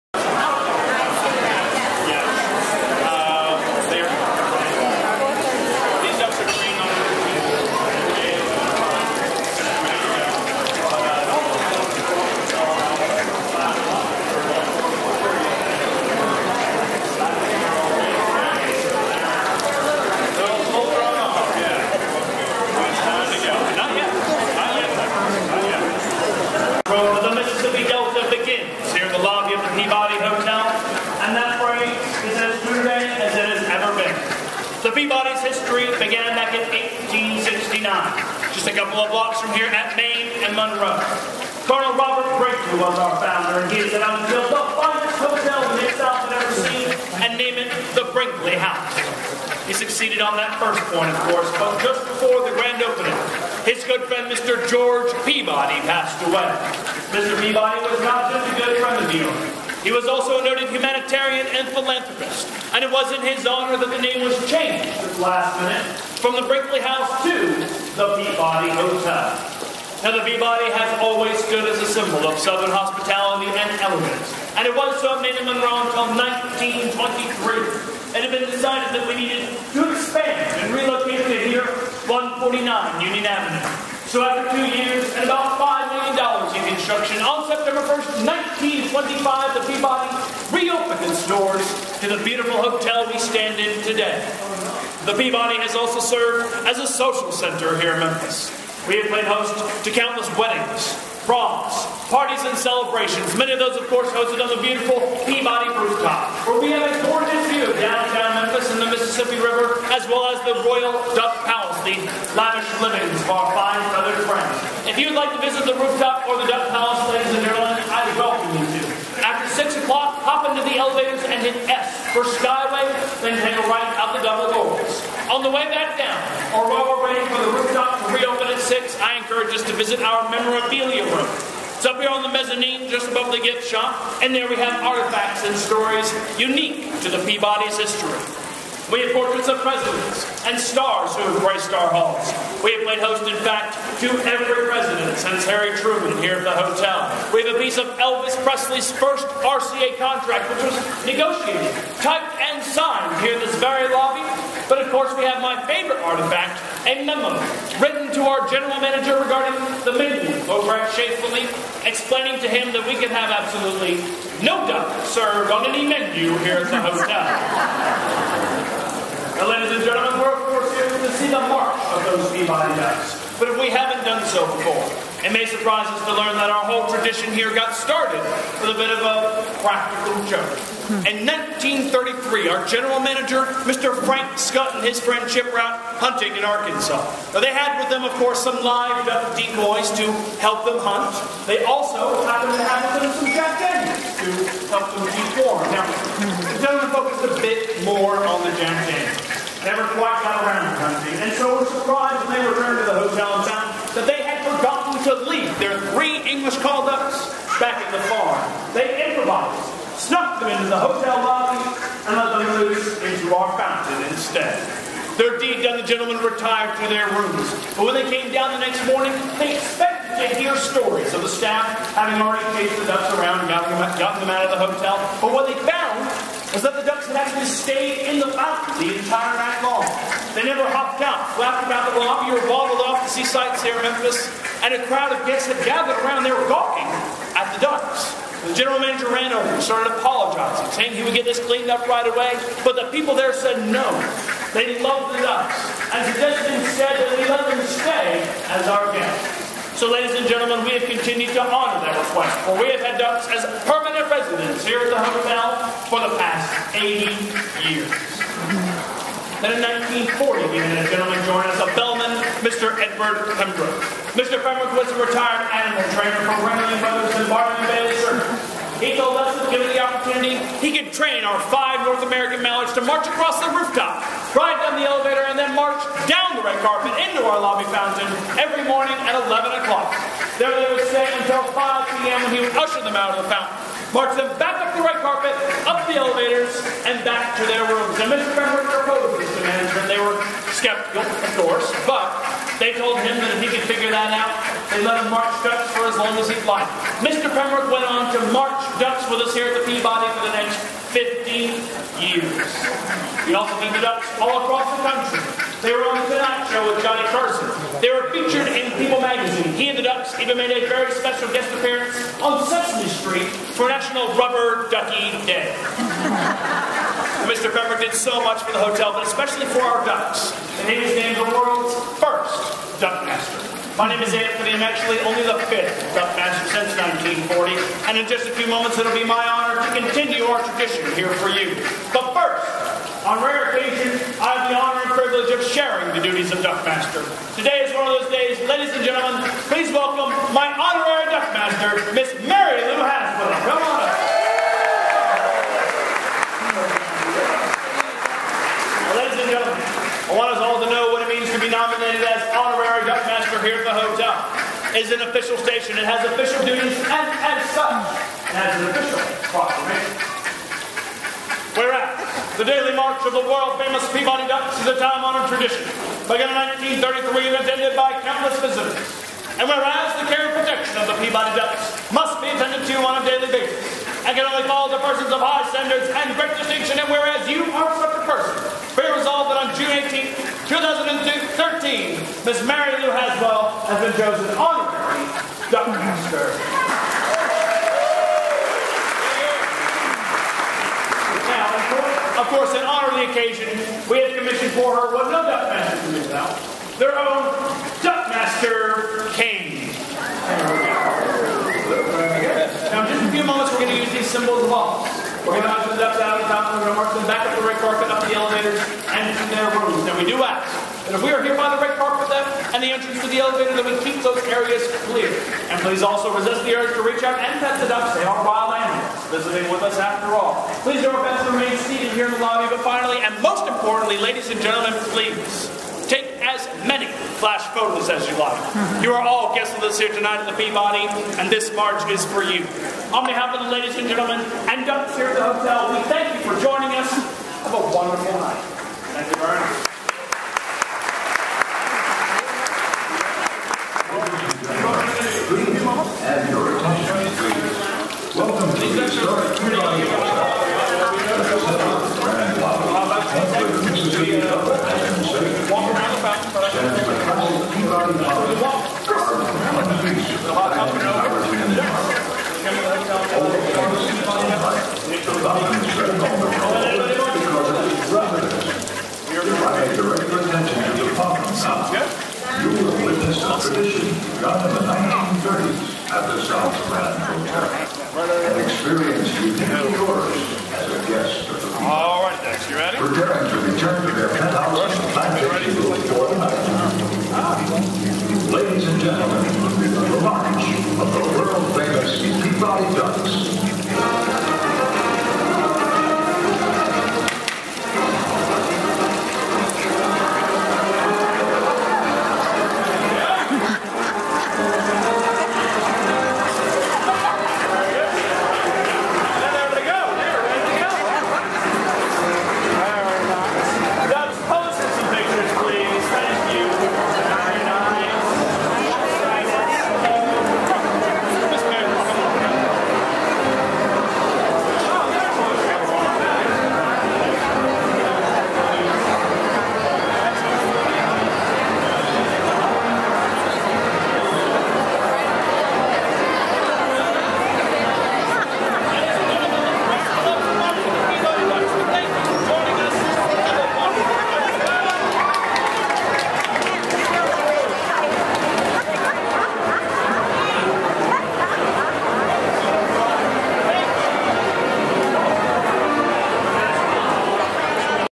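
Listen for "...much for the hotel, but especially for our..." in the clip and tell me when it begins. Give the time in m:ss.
5:18.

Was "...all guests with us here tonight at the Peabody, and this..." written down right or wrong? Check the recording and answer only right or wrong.
right.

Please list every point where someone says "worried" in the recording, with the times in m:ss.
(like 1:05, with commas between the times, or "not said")
not said.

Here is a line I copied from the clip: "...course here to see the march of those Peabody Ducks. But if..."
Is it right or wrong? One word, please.
right.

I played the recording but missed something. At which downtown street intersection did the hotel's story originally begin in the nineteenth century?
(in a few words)
Main and Monroe.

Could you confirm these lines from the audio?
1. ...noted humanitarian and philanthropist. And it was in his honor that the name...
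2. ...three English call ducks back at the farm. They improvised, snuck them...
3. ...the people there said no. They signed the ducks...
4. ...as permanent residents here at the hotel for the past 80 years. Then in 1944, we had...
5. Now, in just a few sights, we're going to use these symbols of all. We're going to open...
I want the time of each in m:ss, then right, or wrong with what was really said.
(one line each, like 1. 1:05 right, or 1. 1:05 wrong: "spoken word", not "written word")
1. 1:00 right
2. 3:25 right
3. 4:02 wrong: "loved", not "signed"
4. 4:13 wrong: "1940", not "1944"
5. 6:42 wrong: "moments", not "sights".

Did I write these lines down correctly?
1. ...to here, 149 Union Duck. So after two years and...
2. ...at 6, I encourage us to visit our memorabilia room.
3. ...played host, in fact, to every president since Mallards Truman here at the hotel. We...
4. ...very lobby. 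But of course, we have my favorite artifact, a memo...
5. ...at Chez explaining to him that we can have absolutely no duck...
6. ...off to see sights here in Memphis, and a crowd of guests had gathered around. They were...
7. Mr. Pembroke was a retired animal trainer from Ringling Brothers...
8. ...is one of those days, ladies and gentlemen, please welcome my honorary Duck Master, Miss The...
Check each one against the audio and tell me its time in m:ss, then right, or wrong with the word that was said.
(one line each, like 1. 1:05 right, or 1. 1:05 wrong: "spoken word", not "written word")
1. 1:21 wrong: "Avenue", not "Duck"
2. 2:08 right
3. 2:22 wrong: "Harry", not "Mallards"
4. 2:33 right
5. 2:40 right
6. 3:52 right
7. 4:24 right
8. 5:37 wrong: "Mary", not "The".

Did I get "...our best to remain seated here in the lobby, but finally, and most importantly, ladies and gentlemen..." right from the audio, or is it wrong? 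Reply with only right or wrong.
right.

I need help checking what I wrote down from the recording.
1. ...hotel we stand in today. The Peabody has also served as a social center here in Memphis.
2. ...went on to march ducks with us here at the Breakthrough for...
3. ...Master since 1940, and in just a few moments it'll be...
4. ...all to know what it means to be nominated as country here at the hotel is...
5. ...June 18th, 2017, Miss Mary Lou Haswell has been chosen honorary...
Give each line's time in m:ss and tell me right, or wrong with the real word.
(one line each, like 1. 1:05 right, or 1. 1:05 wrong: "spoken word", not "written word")
1. 1:32 right
2. 4:57 wrong: "Peabody", not "Breakthrough"
3. 5:26 right
4. 5:50 wrong: "honorary", not "country"
5. 6:19 wrong: "2013", not "2017".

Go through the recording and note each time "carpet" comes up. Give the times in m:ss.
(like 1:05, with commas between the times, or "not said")
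4:36, 4:45, 6:47, 6:51.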